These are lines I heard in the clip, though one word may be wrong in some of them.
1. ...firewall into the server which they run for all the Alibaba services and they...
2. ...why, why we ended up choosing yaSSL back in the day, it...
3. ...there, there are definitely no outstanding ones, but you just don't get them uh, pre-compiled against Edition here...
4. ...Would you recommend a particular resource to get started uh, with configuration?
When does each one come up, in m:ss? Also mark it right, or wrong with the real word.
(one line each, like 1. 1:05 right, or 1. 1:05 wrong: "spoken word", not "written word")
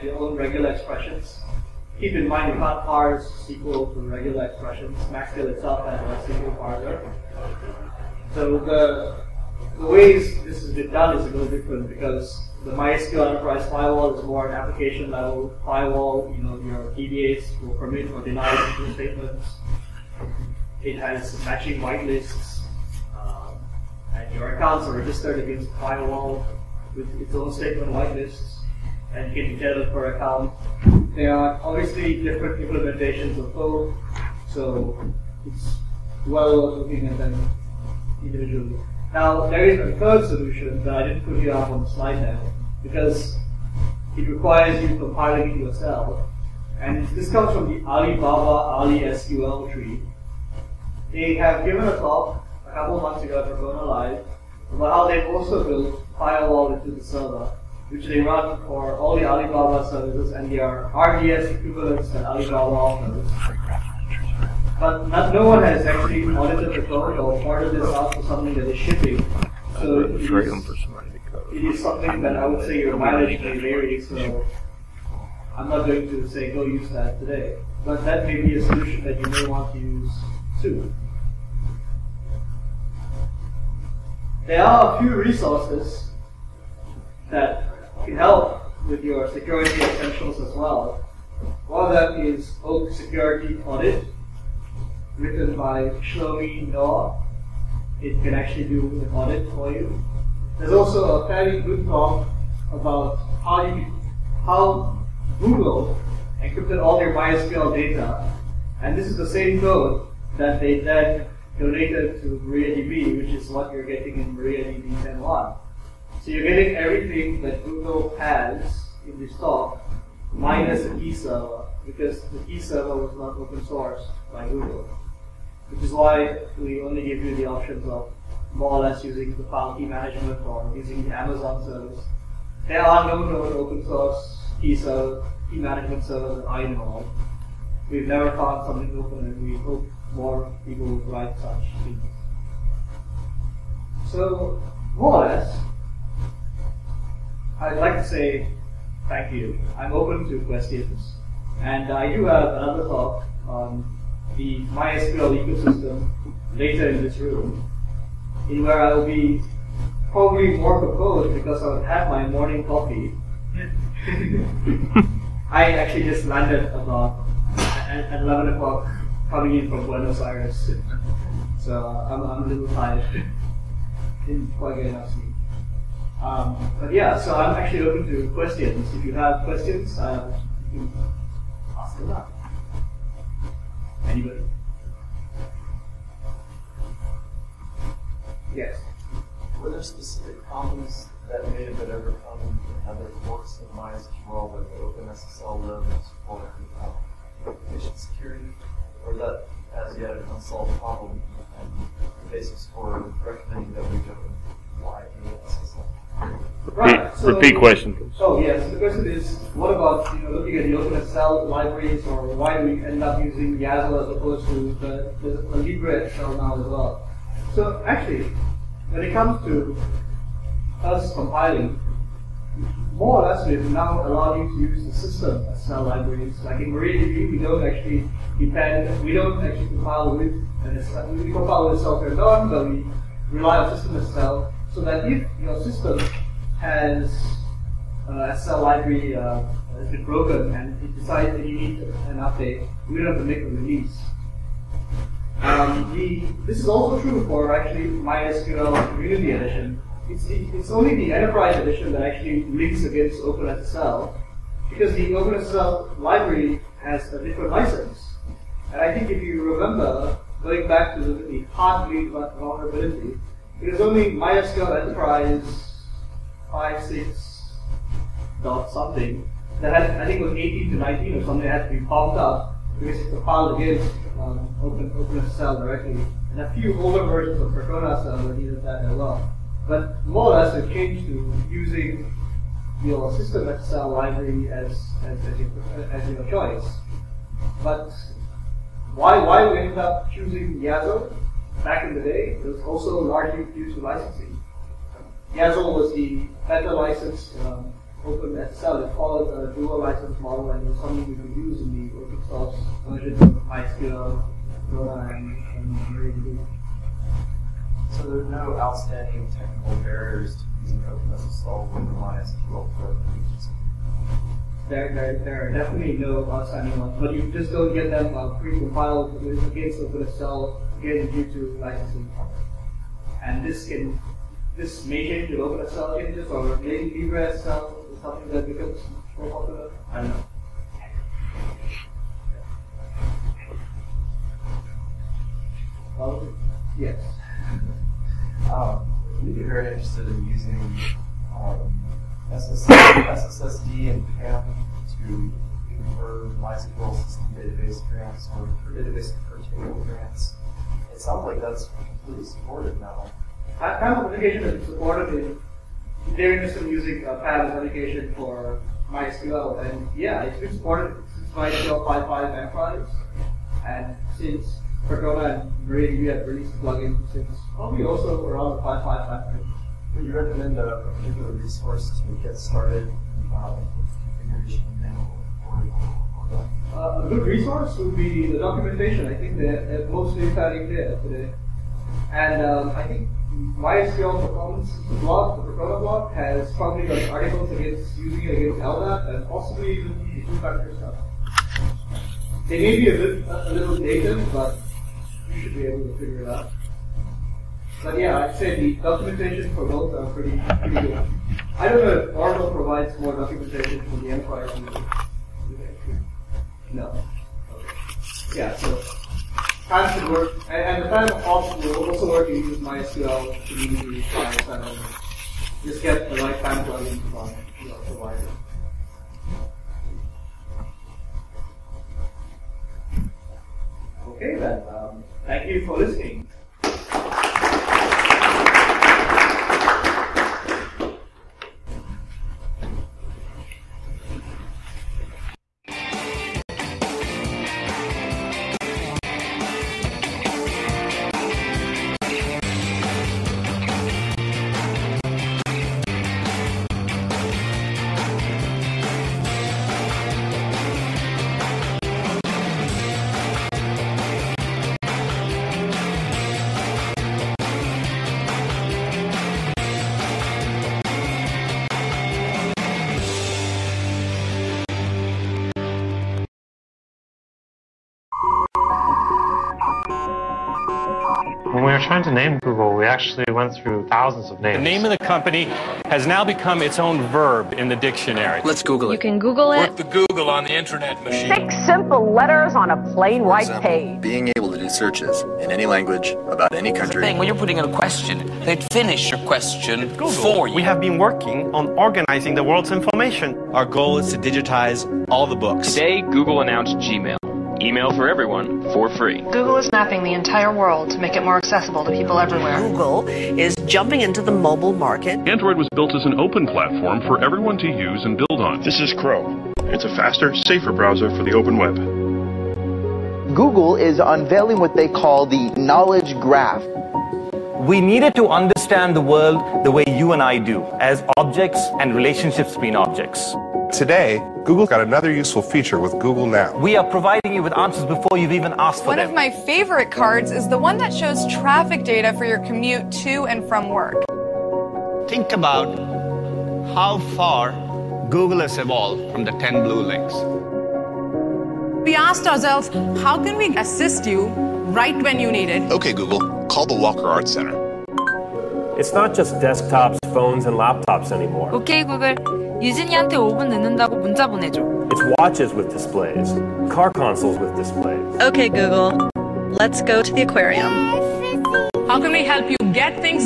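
1. 0:56 right
2. 4:48 right
3. 5:14 wrong: "OpenSSL", not "Edition"
4. 6:09 right.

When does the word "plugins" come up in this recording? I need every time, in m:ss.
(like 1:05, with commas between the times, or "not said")
6:06, 6:56.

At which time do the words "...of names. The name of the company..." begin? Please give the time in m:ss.
7:54.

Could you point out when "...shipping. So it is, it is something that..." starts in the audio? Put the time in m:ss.
1:08.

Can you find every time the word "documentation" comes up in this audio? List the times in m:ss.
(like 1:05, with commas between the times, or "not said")
6:18, 6:38, 6:43.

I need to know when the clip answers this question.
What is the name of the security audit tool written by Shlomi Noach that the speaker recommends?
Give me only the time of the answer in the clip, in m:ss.
1:32.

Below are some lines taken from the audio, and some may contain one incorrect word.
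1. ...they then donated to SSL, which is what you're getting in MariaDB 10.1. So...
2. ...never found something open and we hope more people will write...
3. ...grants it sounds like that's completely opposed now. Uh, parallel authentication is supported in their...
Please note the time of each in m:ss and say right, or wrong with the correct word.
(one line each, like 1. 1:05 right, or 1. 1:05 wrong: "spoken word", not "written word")
1. 1:50 wrong: "MariaDB", not "SSL"
2. 2:18 right
3. 5:49 wrong: "supported", not "opposed".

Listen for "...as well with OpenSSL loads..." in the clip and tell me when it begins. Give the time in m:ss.
3:13.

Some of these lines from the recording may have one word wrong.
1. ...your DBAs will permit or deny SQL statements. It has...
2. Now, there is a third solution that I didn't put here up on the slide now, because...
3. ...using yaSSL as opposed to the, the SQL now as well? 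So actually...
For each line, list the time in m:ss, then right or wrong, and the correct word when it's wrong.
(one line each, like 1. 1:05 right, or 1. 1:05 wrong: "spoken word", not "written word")
1. 0:16 right
2. 0:39 right
3. 3:33 wrong: "LibreSSL", not "SQL".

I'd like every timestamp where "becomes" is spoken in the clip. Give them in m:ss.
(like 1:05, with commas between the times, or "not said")
5:28, 7:56.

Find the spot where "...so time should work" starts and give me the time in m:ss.
6:48.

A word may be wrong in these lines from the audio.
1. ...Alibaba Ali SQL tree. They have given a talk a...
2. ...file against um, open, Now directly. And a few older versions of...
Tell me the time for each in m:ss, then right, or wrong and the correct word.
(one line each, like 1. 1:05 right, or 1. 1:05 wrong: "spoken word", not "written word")
1. 0:47 right
2. 4:33 wrong: "OpenSSL", not "Now".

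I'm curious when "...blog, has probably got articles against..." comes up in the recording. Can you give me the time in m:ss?
6:25.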